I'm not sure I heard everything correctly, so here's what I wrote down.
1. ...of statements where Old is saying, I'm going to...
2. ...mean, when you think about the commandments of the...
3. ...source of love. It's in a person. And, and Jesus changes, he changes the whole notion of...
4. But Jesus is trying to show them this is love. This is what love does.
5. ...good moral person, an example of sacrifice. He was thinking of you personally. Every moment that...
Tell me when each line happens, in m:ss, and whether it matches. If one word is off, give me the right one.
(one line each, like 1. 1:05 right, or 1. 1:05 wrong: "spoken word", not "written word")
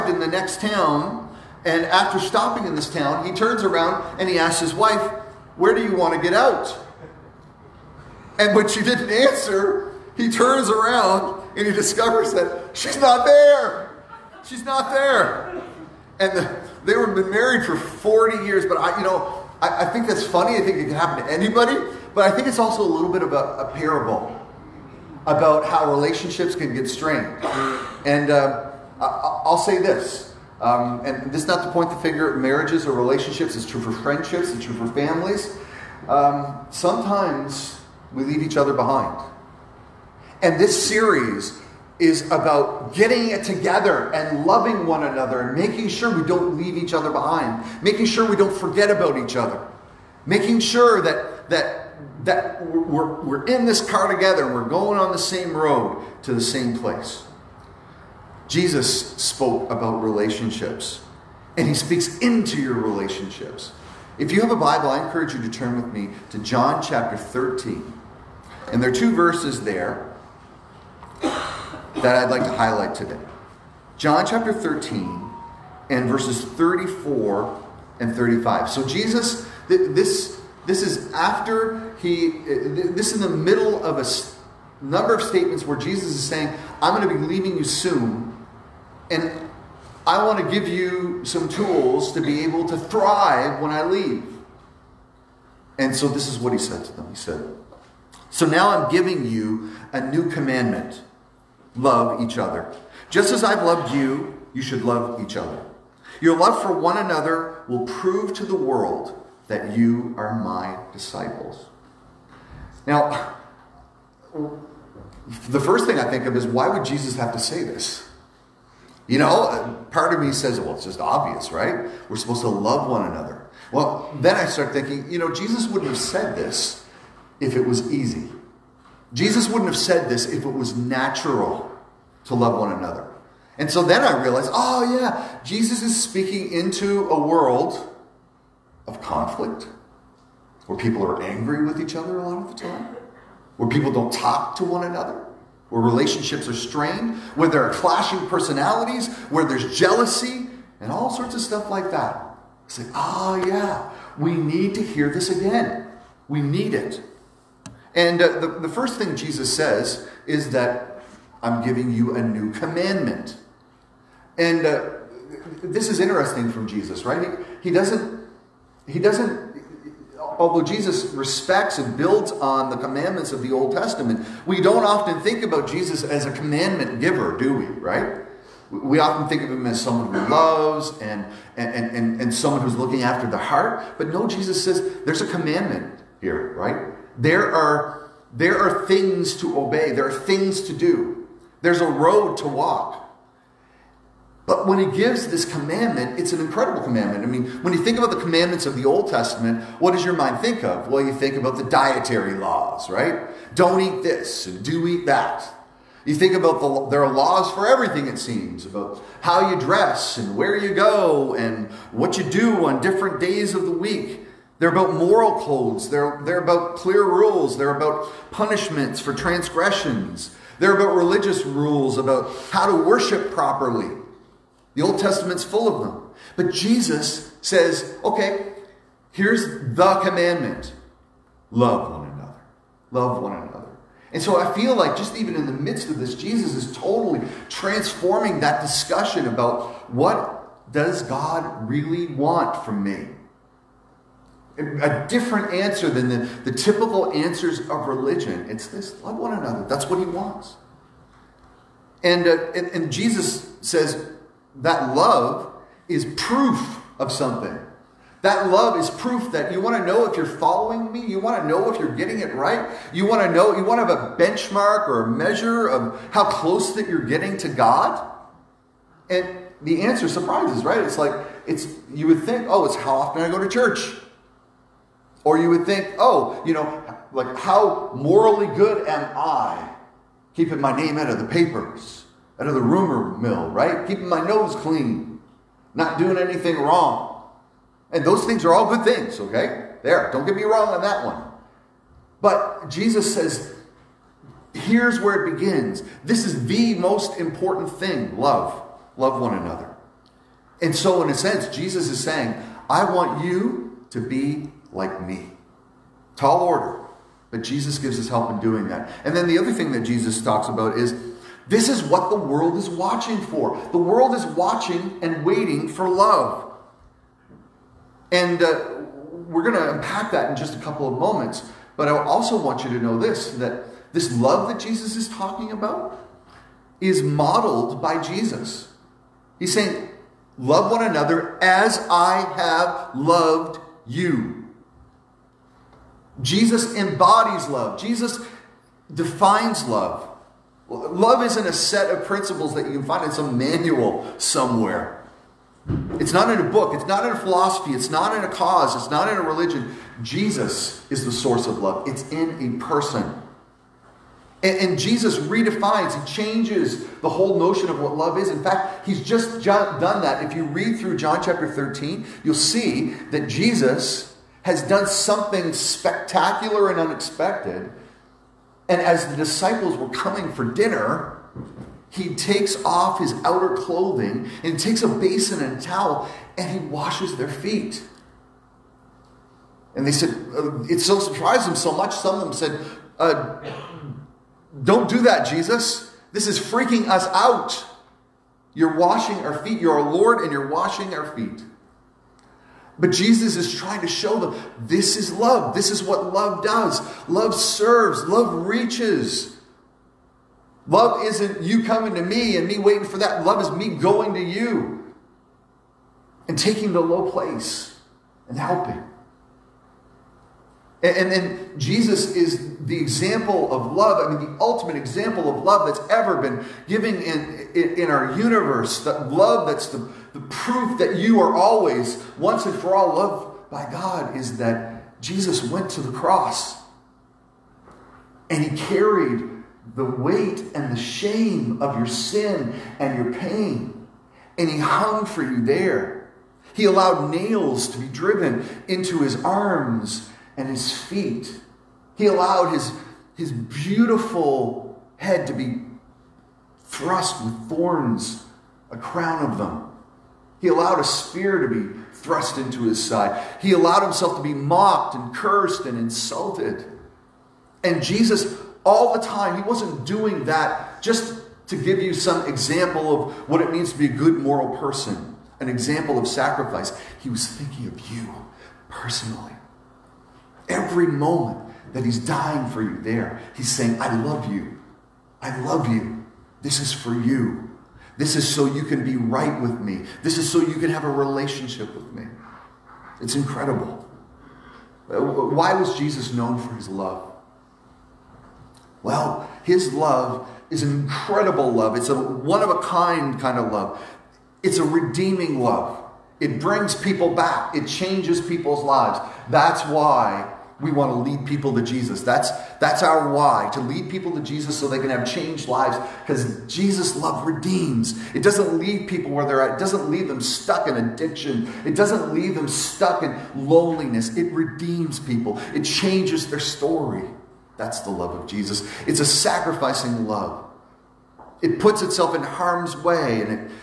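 1. 1:25 wrong: "Jesus", not "Old"
2. 3:17 right
3. 5:51 wrong: "redefines", not "changes"
4. 6:32 right
5. 7:43 right.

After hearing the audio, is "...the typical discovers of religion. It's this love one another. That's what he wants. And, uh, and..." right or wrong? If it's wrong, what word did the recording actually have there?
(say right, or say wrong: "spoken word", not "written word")
wrong: "answers", not "discovers".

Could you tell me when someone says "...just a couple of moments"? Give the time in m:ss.
5:20.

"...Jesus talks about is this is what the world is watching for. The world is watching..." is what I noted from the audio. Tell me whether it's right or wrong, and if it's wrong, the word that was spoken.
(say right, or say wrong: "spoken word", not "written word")
right.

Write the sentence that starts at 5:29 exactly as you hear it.
He's saying, Love one another as I have loved you.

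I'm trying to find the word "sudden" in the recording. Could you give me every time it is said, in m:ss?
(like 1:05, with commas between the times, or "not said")
not said.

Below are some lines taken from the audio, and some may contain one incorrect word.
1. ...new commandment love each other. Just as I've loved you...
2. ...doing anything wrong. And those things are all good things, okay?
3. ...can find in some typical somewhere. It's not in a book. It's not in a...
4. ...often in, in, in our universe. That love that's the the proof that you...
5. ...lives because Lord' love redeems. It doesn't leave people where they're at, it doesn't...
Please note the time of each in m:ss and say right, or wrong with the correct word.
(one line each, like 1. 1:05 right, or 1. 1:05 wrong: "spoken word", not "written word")
1. 1:40 right
2. 4:45 right
3. 5:42 wrong: "manual", not "typical"
4. 6:56 wrong: "given", not "often"
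5. 8:25 wrong: "Jesus", not "Lord".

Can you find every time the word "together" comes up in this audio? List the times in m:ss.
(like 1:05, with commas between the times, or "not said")
0:43, 0:54.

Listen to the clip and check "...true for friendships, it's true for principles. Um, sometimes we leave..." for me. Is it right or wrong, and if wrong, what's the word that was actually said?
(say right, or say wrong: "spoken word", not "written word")
wrong: "families", not "principles".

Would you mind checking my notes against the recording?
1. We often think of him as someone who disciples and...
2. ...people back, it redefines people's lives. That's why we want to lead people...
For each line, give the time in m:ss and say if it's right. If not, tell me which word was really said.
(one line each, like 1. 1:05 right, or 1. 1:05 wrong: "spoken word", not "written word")
1. 2:58 wrong: "loves", not "disciples"
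2. 8:16 wrong: "changes", not "redefines".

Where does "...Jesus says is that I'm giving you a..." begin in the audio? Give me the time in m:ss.
2:39.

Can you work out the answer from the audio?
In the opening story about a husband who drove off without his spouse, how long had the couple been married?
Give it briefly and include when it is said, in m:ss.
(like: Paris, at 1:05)
40 years, at 0:17.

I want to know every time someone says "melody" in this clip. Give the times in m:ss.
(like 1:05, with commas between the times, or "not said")
not said.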